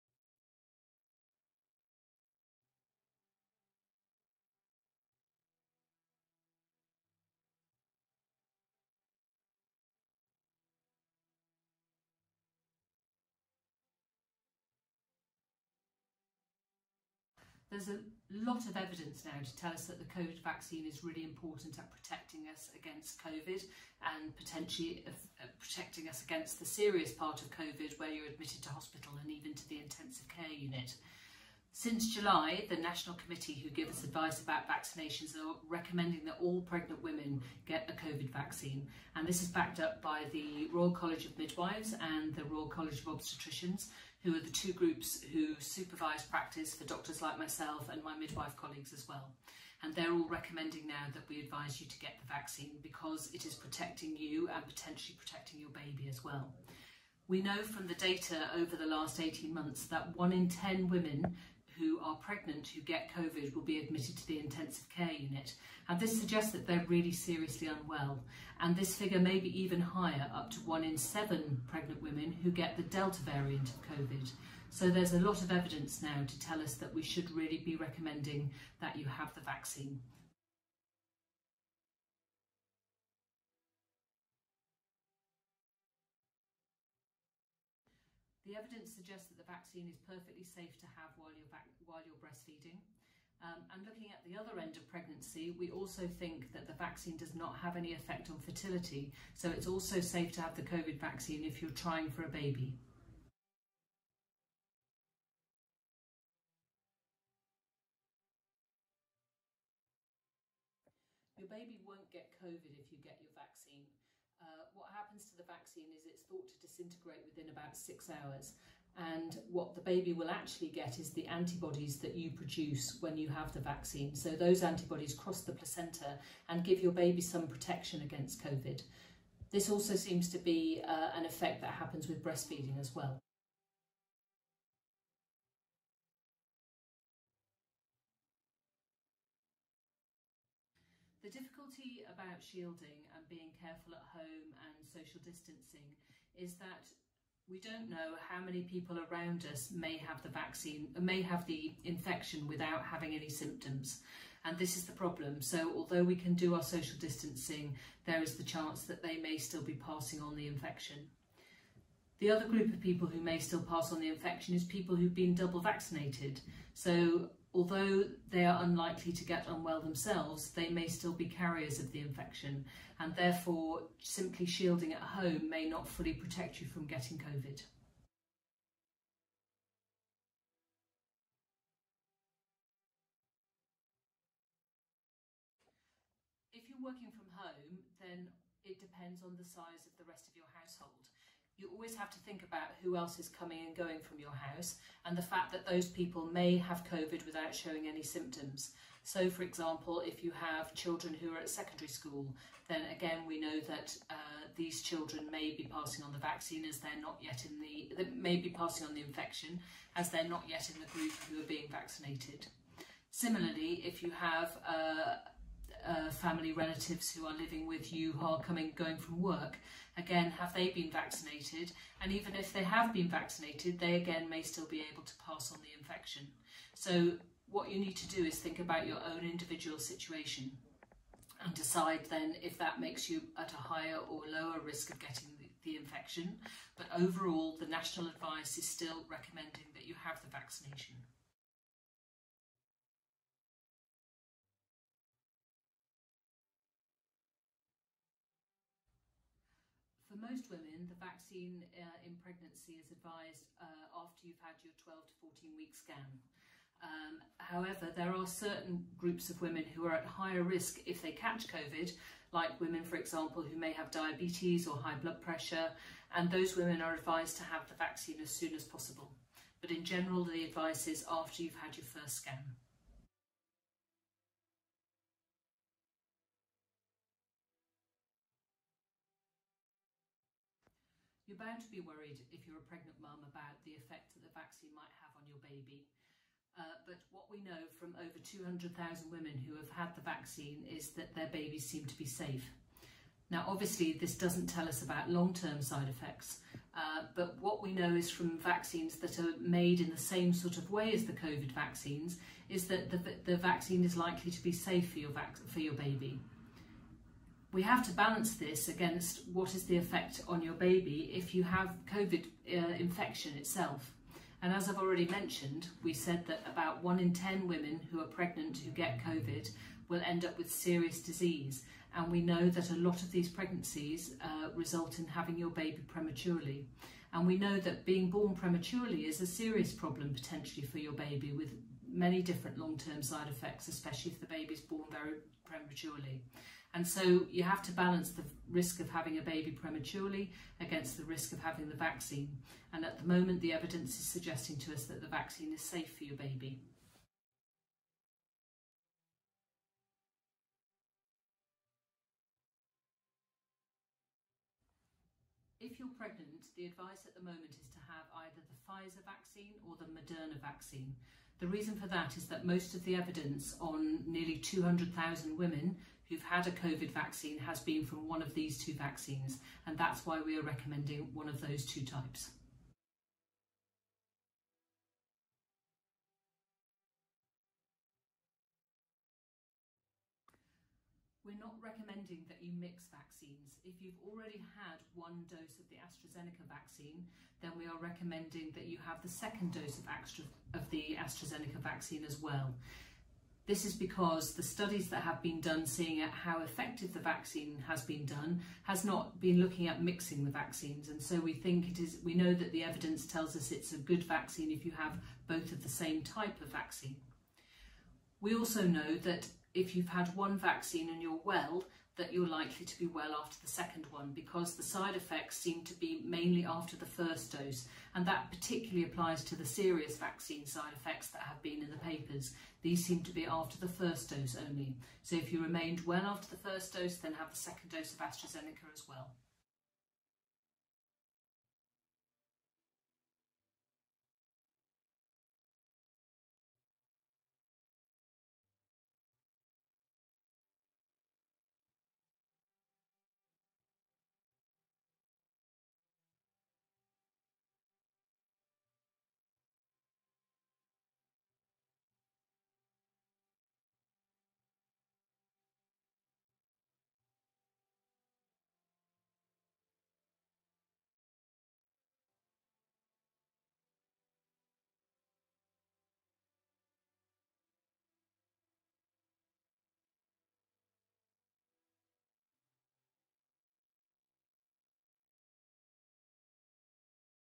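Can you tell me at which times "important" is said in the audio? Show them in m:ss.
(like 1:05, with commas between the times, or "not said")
0:21.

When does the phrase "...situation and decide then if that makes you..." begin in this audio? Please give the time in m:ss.
3:49.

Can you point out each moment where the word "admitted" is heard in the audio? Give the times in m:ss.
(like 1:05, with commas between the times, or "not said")
0:28, 1:03.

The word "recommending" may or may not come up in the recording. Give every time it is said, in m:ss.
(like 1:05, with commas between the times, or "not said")
0:35, 0:50, 1:17, 3:59, 6:10, 6:21, 6:27.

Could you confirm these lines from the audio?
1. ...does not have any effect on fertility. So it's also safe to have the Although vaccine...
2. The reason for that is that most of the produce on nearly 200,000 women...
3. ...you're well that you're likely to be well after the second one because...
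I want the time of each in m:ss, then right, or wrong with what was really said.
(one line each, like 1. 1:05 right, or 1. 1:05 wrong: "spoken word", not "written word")
1. 1:37 wrong: "COVID", not "Although"
2. 6:01 wrong: "evidence", not "produce"
3. 6:51 right.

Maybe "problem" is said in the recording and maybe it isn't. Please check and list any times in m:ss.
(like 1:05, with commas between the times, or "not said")
2:34, 5:29.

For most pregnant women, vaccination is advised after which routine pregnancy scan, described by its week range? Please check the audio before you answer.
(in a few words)
12 to 14 week scan.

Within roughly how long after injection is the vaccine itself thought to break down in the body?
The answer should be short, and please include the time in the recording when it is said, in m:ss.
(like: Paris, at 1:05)
6 hours, at 1:57.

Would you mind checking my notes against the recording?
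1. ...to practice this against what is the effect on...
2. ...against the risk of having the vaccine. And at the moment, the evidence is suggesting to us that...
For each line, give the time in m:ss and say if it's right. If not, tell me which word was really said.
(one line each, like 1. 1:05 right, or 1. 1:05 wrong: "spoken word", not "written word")
1. 5:07 wrong: "balance", not "practice"
2. 5:40 right.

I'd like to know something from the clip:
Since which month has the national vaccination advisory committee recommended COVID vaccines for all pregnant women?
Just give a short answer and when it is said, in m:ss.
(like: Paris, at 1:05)
July, at 0:32.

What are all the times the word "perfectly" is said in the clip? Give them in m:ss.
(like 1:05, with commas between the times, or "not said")
1:30.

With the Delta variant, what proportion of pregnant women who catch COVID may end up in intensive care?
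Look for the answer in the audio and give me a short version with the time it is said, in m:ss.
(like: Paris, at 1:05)
1 in 7, at 1:10.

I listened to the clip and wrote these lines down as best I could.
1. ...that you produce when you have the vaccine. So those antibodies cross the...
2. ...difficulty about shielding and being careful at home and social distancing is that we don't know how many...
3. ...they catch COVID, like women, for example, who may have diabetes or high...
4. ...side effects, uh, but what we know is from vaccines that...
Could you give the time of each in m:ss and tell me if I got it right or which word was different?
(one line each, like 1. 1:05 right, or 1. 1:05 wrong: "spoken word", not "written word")
1. 2:01 right
2. 2:21 right
3. 4:21 right
4. 4:55 right.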